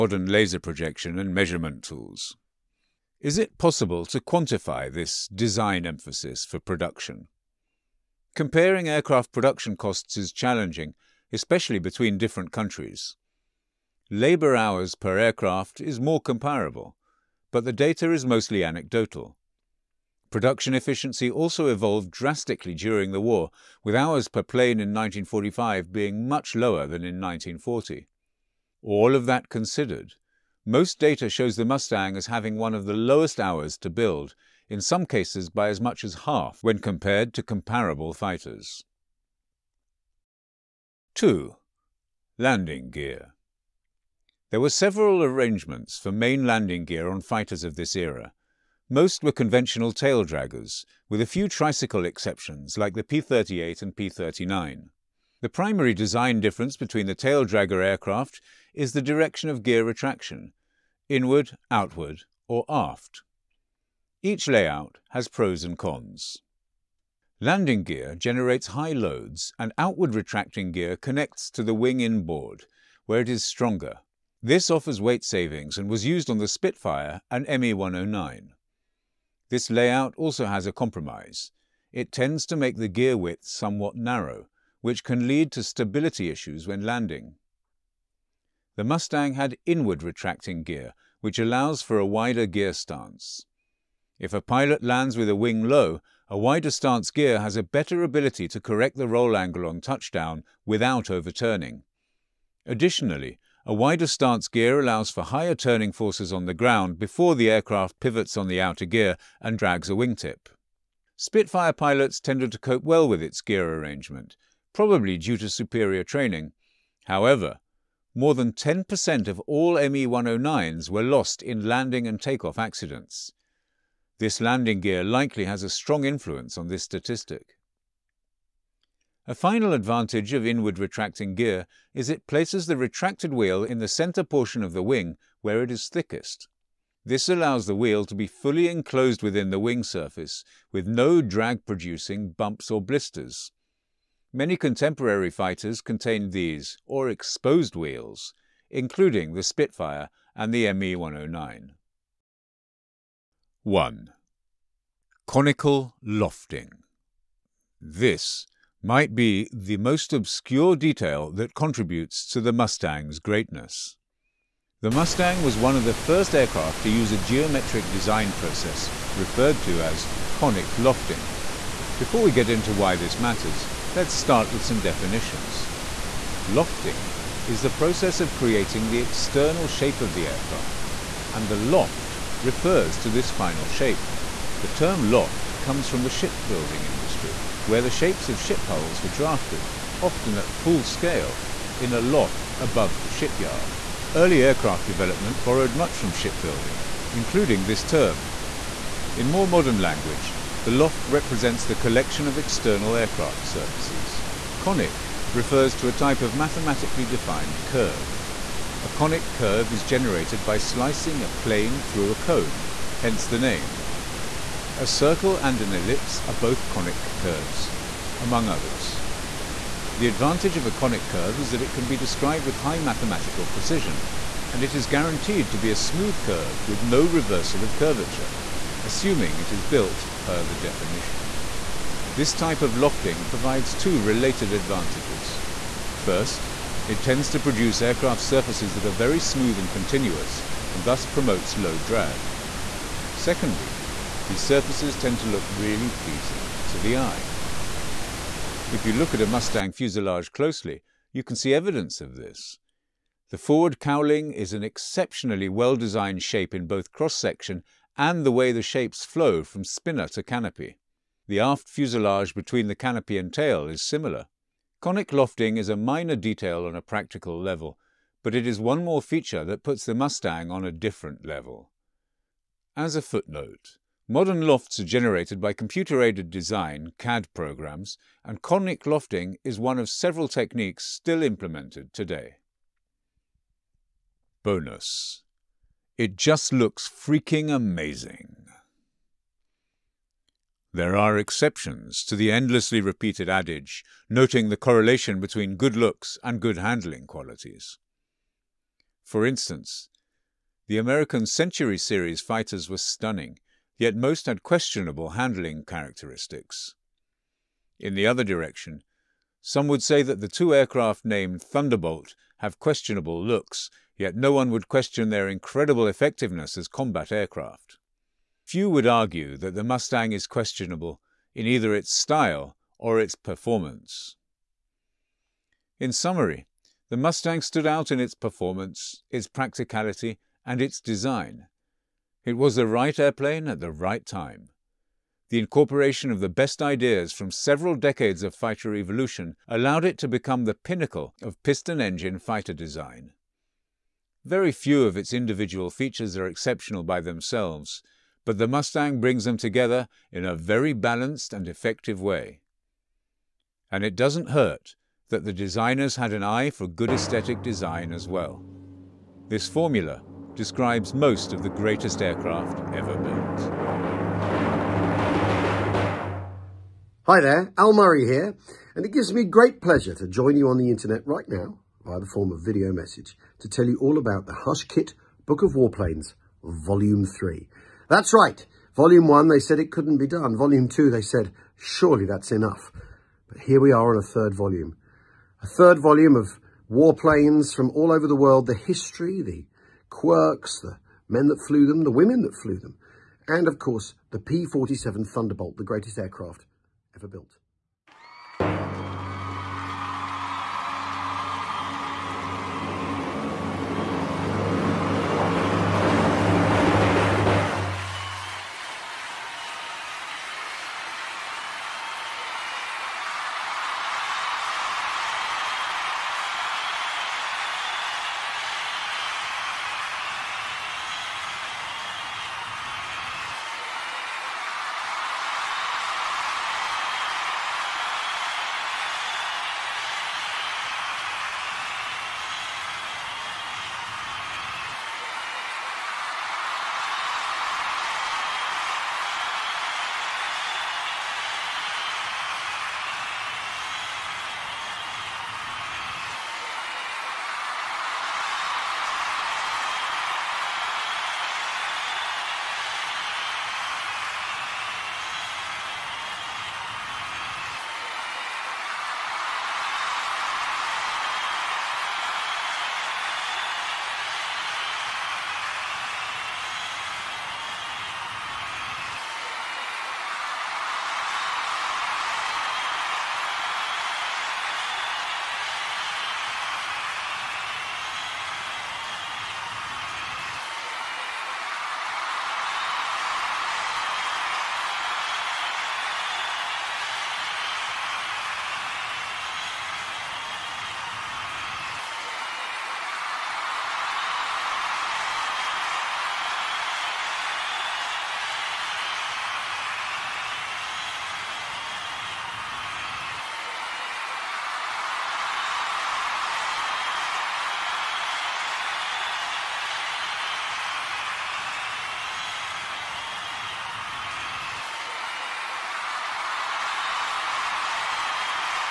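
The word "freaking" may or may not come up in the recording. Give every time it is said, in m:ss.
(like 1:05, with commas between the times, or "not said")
4:46.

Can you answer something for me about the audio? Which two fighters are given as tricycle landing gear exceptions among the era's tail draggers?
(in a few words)
P-38 and P-39.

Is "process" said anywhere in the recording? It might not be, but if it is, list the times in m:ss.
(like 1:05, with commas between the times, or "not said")
2:48, 2:57.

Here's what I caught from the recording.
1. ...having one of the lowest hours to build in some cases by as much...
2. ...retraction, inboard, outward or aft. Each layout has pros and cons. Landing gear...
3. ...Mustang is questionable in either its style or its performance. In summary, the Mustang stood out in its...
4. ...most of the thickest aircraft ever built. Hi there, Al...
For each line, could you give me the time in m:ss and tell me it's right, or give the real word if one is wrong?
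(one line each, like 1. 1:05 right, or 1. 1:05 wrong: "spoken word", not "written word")
1. 0:32 right
2. 0:59 wrong: "inward", not "inboard"
3. 5:19 right
4. 6:00 wrong: "greatest", not "thickest".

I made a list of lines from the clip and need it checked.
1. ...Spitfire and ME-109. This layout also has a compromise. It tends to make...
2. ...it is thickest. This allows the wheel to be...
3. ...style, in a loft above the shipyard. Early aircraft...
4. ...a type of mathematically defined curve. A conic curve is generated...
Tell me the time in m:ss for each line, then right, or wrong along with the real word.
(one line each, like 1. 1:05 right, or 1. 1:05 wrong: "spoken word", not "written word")
1. 1:16 right
2. 2:15 right
3. 3:10 wrong: "scale", not "style"
4. 3:25 right.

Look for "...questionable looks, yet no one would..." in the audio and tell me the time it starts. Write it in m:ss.
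5:12.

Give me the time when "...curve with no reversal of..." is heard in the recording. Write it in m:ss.
3:46.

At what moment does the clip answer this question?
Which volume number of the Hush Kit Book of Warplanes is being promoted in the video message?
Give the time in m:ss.
6:16.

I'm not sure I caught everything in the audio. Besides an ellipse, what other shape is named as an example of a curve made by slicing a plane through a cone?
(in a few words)
circle.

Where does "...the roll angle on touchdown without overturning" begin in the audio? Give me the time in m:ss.
1:38.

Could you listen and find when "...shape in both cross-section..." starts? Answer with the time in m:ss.
4:16.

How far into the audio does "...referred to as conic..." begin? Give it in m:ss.
2:49.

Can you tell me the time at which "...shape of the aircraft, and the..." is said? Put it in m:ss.
2:59.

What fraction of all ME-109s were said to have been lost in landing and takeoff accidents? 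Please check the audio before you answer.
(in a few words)
more than 10%.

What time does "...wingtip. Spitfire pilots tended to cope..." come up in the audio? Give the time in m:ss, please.
1:49.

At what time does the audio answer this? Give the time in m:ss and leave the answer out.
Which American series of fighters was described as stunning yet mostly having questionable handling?
5:01.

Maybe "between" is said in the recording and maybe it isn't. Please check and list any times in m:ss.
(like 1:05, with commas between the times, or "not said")
0:11, 0:56, 4:22, 4:55.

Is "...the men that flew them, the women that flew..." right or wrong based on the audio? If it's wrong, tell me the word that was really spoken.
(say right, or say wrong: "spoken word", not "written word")
right.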